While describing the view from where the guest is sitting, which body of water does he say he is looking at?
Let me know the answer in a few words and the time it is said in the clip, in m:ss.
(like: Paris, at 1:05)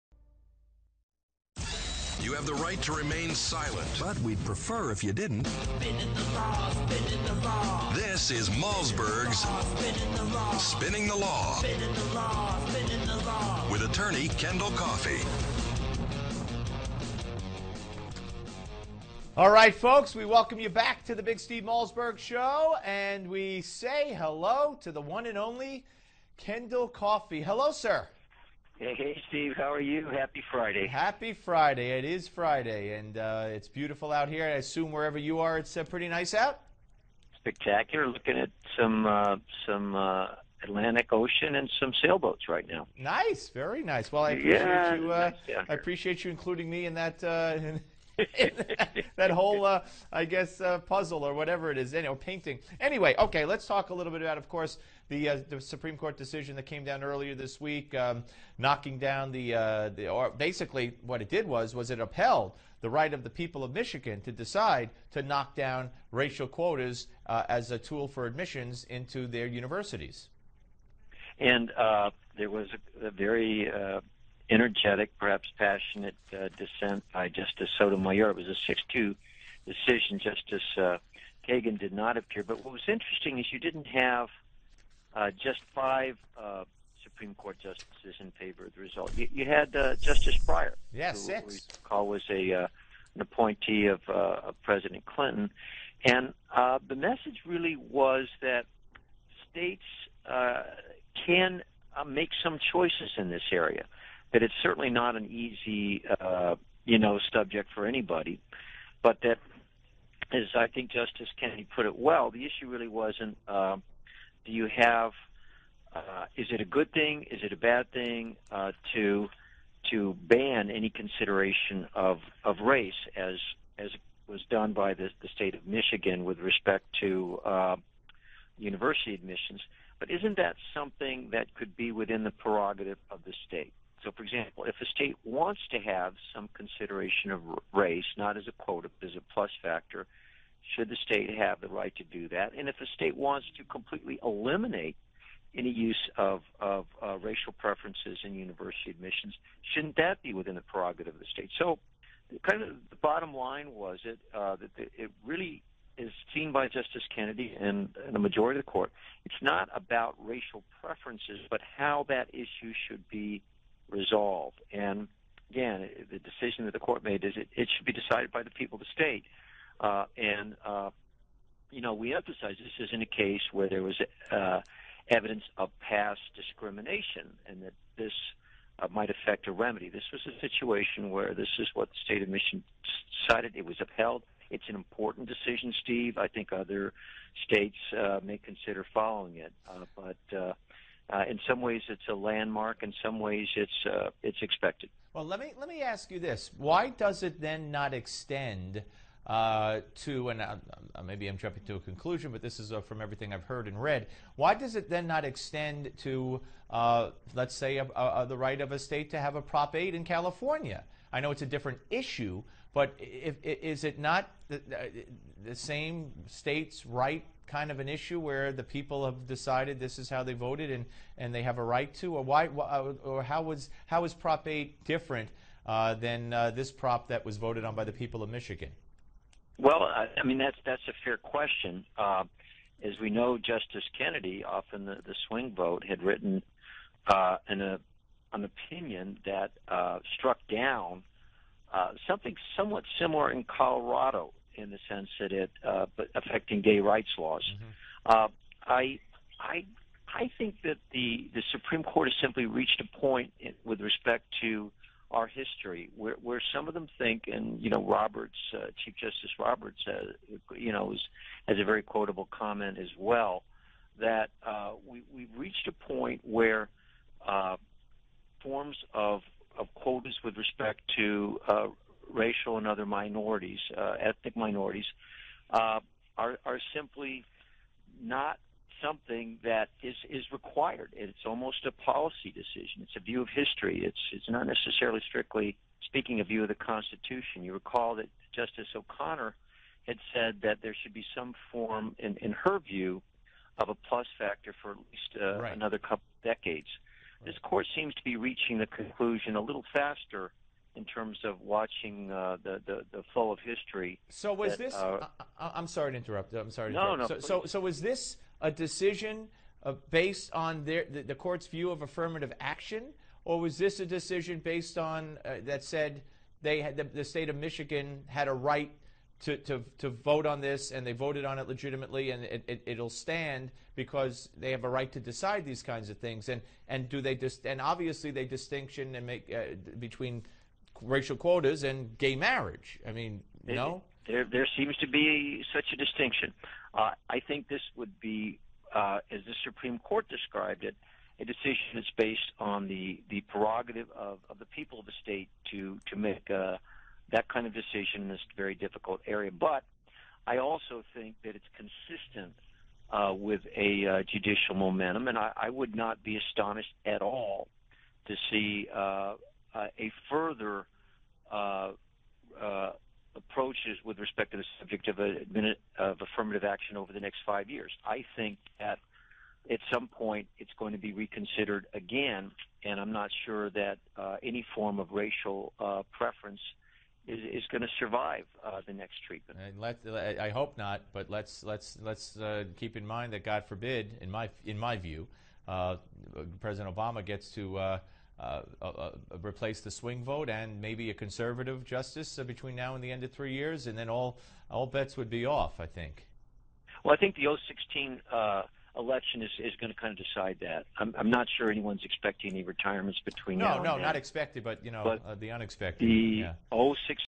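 Atlantic Ocean, at 0:40.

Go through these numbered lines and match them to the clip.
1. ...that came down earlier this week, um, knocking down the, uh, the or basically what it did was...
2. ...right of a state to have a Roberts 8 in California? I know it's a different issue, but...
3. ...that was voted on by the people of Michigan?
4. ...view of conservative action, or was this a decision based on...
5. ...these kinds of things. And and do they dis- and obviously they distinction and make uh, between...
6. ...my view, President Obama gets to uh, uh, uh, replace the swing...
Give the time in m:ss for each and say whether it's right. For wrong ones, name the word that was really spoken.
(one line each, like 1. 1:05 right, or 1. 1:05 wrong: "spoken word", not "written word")
1. 0:56 right
2. 3:28 wrong: "Prop", not "Roberts"
3. 3:47 right
4. 5:11 wrong: "affirmative", not "conservative"
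5. 5:25 right
6. 6:24 right.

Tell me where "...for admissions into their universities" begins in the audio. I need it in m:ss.
1:08.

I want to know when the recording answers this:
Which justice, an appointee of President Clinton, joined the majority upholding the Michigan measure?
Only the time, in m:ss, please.
1:29.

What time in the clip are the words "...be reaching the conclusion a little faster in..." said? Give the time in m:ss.
4:58.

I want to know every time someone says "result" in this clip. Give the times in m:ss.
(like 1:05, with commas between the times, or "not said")
1:28.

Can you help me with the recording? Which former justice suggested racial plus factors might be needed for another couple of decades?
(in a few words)
Justice O'Connor.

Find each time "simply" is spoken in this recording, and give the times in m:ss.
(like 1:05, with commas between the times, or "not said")
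4:12, 4:36.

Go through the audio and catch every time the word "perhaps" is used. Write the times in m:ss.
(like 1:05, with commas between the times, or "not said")
1:15.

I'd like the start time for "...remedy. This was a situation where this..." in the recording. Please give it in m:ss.
2:59.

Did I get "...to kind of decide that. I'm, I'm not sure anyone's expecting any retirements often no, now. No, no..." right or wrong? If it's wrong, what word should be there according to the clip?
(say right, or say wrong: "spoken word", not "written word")
wrong: "between", not "often".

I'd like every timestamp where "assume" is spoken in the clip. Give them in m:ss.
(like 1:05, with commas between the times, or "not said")
0:34.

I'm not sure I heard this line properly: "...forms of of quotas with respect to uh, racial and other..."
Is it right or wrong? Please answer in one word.
right.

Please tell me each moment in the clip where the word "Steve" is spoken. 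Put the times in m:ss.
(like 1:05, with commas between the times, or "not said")
0:21, 0:29, 3:05.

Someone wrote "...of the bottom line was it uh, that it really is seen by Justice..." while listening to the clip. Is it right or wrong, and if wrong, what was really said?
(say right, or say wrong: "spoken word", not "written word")
right.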